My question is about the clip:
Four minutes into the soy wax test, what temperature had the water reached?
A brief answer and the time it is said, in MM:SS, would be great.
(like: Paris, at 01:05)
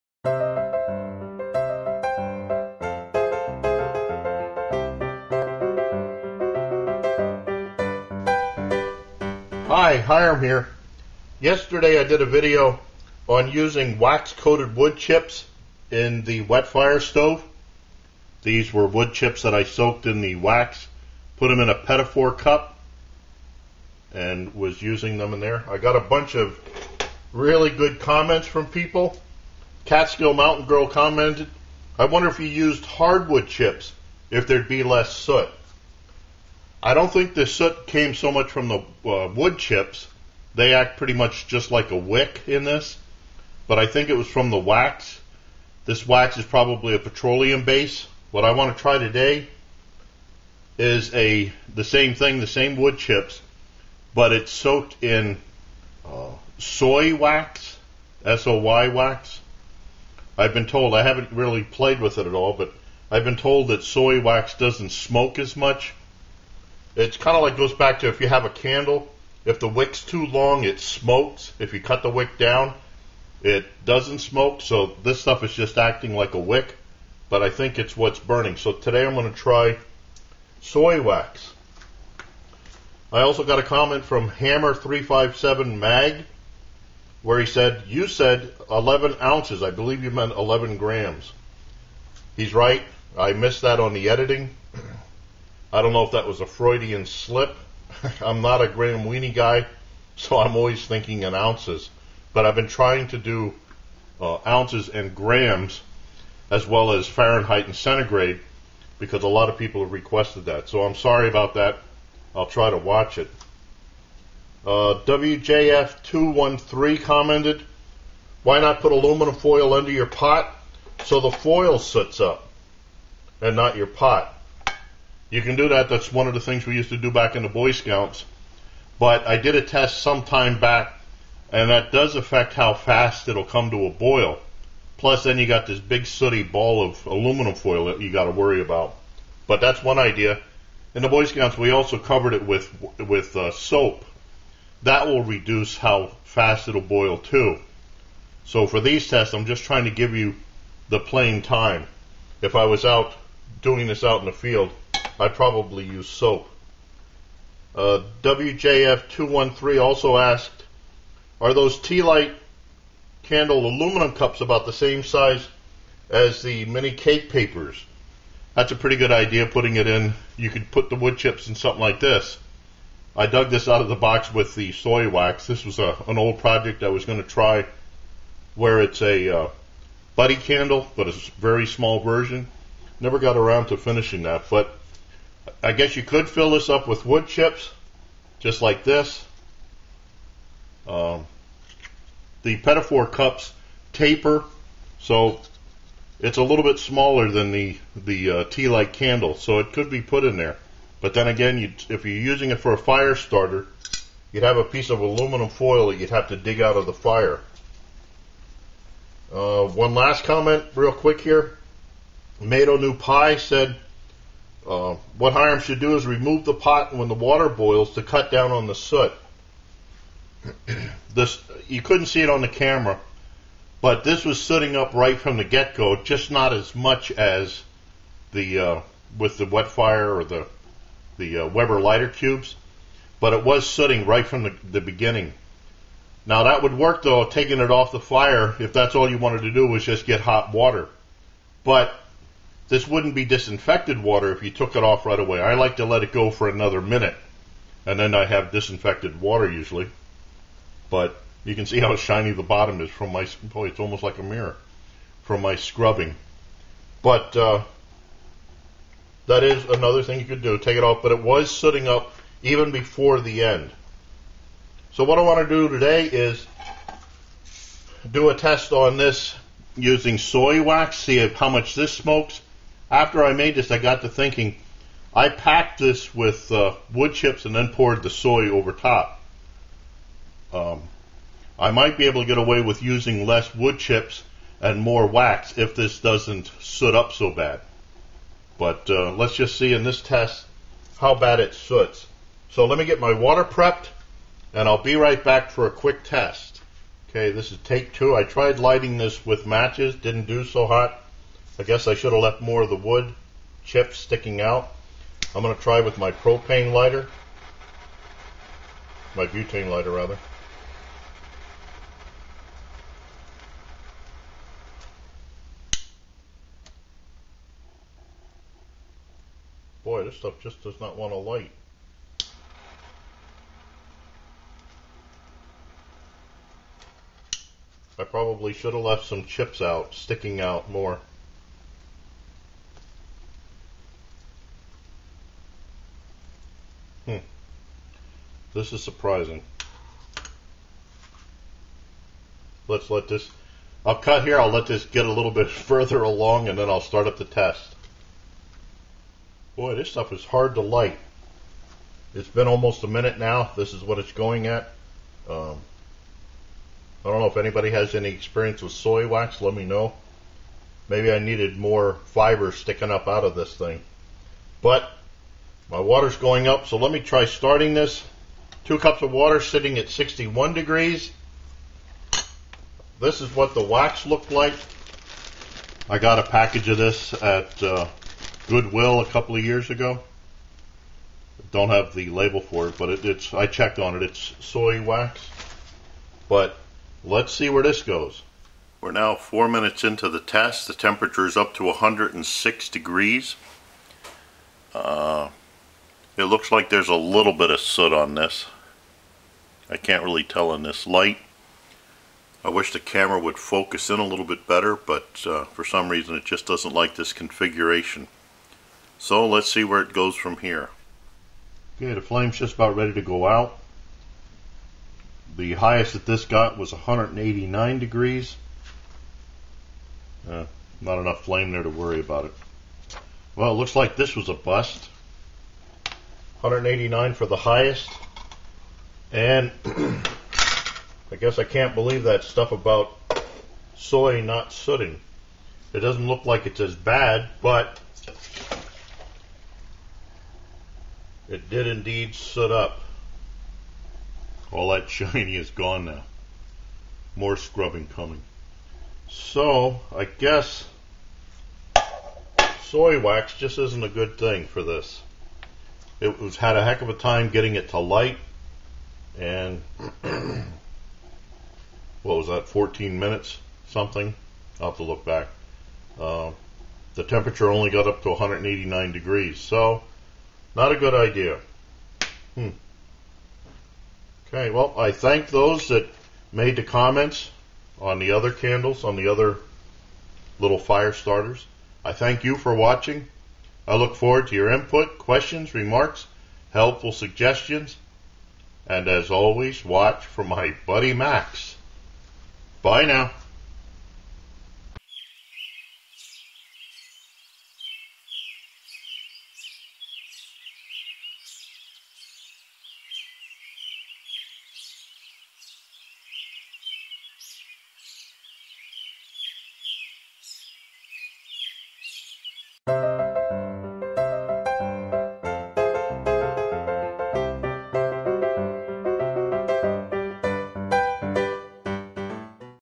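106 degrees, at 06:31.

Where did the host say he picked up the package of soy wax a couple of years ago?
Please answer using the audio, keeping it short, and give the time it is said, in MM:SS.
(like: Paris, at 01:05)
Goodwill, at 06:18.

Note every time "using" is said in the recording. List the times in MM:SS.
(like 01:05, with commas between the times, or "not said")
00:13, 00:24, 03:22, 04:29, 04:42.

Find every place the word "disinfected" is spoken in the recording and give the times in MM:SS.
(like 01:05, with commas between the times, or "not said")
04:03, 04:08.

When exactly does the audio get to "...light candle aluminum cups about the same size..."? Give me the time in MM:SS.
02:42.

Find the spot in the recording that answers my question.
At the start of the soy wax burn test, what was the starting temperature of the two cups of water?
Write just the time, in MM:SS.
06:09.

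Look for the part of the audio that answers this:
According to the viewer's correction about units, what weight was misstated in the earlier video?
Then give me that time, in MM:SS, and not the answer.
01:30.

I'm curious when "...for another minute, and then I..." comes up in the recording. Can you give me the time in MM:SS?
04:06.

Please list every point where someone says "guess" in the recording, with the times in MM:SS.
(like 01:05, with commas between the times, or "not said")
03:05, 05:01, 07:11, 07:30.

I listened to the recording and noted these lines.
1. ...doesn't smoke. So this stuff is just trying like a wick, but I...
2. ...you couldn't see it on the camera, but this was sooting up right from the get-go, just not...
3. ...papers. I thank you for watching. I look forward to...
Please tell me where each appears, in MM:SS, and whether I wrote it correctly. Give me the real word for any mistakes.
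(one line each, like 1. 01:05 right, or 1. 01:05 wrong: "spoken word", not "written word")
1. 01:13 wrong: "acting", not "trying"
2. 03:41 right
3. 08:00 wrong: "starters", not "papers".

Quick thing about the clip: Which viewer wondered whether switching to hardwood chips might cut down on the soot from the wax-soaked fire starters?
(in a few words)
Catskill Mountain Girl.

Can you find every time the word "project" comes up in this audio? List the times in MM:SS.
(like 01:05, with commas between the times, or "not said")
02:56.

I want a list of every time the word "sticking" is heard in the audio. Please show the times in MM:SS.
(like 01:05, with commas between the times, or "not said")
05:03, 05:29, 06:02.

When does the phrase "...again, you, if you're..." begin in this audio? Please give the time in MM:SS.
03:21.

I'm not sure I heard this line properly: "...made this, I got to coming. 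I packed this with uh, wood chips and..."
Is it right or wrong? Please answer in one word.
wrong.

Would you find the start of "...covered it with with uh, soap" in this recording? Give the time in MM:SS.
02:21.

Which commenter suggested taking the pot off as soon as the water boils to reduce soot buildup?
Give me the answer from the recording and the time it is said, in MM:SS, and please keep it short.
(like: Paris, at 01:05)
MatoNupai, at 03:32.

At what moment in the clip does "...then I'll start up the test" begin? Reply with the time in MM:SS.
05:46.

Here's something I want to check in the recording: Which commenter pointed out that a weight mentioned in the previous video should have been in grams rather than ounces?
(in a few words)
Hammer357Mag.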